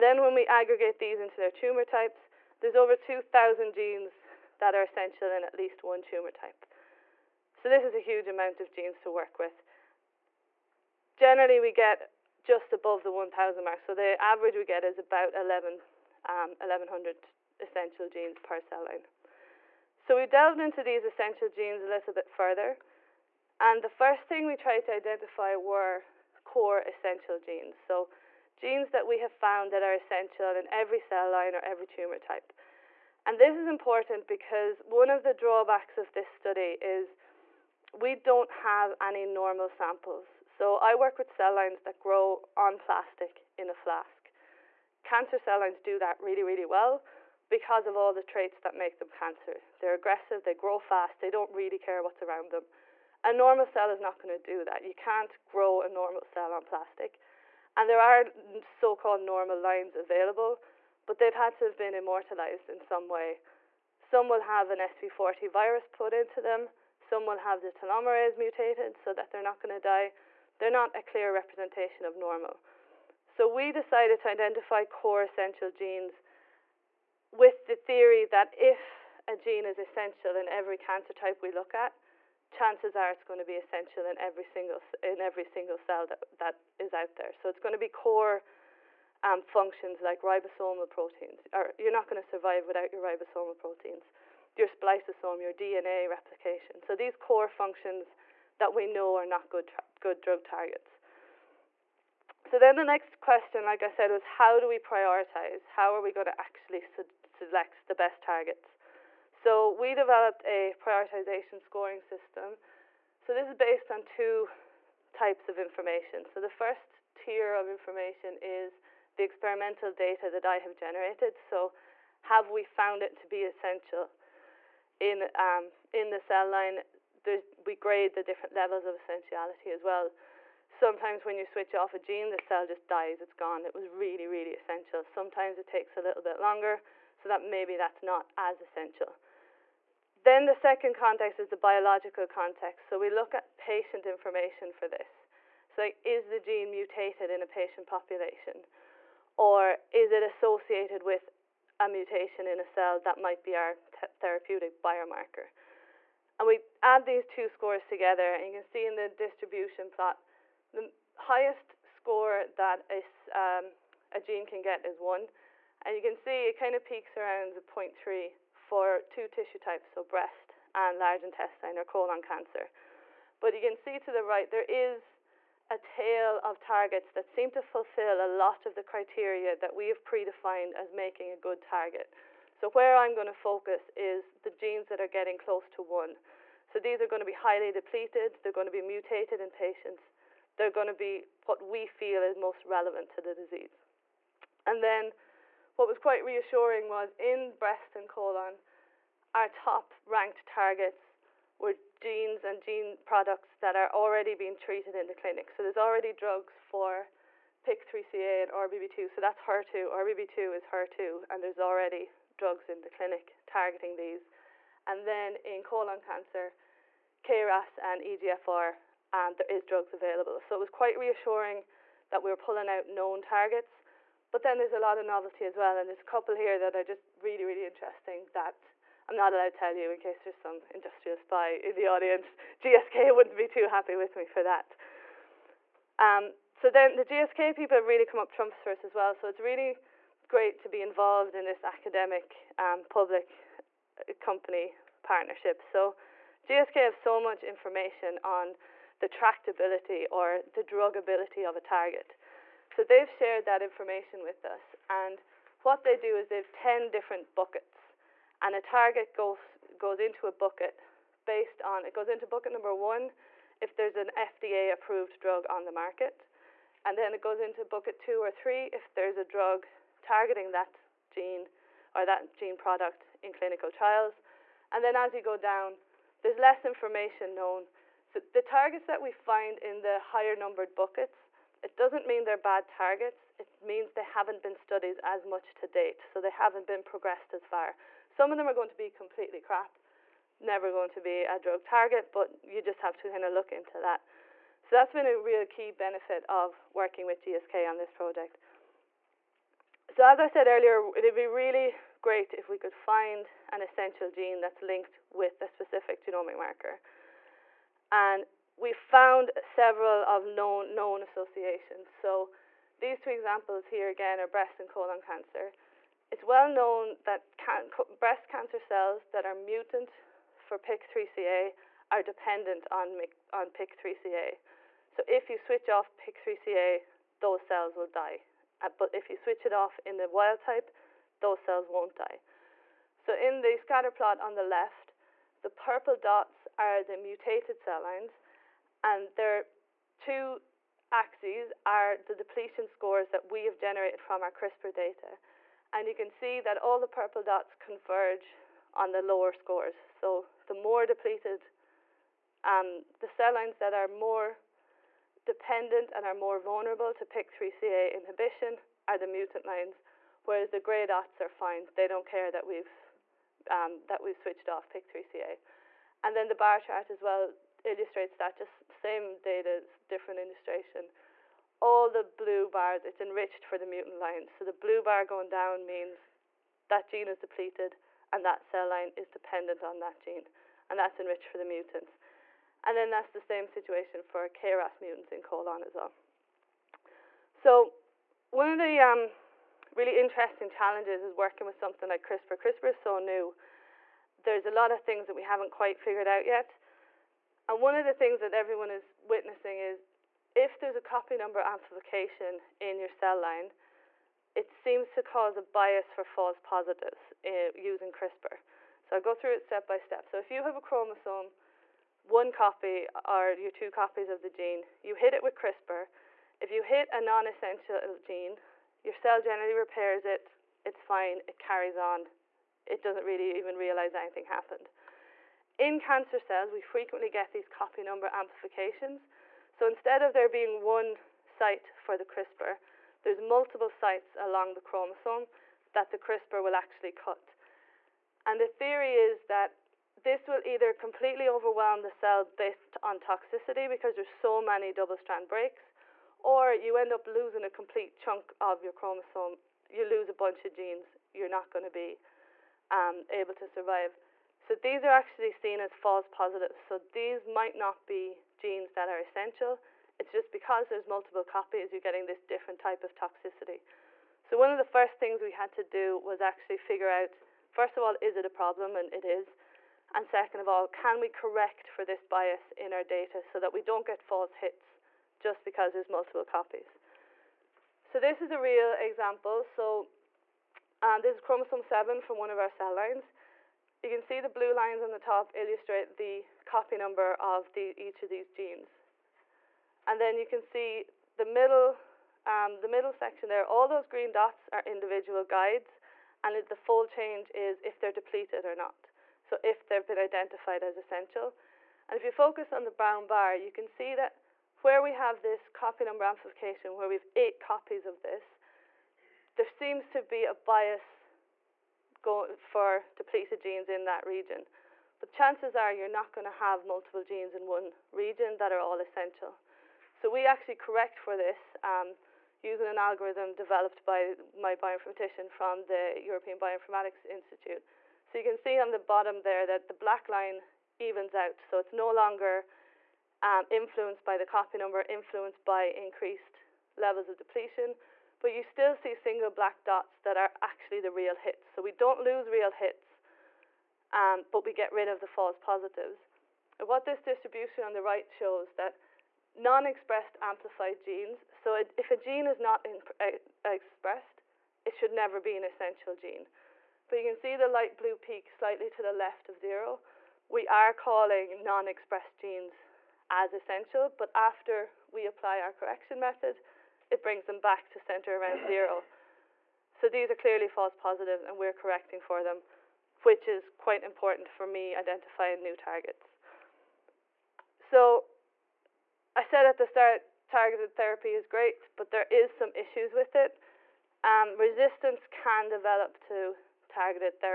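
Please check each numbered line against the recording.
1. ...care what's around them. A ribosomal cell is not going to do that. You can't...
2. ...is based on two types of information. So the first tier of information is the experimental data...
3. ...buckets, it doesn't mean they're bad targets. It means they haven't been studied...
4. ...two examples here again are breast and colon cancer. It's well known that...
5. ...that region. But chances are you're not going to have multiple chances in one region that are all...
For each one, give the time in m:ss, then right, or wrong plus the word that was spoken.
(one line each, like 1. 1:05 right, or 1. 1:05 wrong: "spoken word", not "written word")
1. 0:51 wrong: "normal", not "ribosomal"
2. 1:53 right
3. 4:40 right
4. 5:12 right
5. 8:33 wrong: "genes", not "chances".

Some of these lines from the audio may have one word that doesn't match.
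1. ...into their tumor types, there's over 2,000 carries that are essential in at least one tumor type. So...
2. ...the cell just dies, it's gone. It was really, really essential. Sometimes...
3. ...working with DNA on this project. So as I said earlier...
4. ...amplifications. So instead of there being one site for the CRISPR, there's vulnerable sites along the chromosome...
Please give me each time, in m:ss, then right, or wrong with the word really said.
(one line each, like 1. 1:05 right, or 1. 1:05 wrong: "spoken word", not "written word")
1. 0:01 wrong: "genes", not "carries"
2. 2:12 right
3. 4:56 wrong: "GSK", not "DNA"
4. 7:08 wrong: "multiple", not "vulnerable".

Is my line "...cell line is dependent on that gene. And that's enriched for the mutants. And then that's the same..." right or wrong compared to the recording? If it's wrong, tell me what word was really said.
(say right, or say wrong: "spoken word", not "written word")
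right.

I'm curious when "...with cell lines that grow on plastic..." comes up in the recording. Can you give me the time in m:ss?
0:41.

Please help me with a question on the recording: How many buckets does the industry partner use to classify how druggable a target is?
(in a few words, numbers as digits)
10.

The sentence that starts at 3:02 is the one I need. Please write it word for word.
So where I'm going to focus is the genes that are getting close to one.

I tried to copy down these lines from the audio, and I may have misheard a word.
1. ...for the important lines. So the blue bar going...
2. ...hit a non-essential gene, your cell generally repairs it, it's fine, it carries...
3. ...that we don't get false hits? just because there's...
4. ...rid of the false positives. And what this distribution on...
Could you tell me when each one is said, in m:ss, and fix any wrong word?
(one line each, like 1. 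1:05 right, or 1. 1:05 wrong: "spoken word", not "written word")
1. 6:13 wrong: "mutant", not "important"
2. 6:56 right
3. 7:53 right
4. 9:04 right.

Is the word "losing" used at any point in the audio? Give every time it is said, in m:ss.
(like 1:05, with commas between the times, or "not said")
7:27.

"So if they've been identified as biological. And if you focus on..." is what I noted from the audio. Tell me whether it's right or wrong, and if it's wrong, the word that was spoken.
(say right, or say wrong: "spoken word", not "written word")
wrong: "essential", not "biological".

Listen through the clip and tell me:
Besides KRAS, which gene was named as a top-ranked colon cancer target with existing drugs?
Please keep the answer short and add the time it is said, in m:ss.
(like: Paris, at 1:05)
EGFR, at 3:38.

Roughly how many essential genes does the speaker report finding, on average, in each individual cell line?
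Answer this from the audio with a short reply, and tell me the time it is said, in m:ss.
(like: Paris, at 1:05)
1,100, at 0:16.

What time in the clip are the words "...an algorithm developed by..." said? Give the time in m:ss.
8:42.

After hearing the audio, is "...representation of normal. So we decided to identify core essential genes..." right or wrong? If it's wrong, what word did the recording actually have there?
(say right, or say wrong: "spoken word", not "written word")
right.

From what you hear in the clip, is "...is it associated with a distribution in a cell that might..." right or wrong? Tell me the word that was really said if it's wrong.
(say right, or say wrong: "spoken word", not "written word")
wrong: "mutation", not "distribution".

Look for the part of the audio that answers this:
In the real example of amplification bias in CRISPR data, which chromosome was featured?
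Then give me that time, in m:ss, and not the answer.
8:01.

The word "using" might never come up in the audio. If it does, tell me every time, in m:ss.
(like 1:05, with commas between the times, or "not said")
6:47, 8:42.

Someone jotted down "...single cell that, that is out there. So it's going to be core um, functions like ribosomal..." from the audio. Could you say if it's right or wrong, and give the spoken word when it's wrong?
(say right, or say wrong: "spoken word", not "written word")
right.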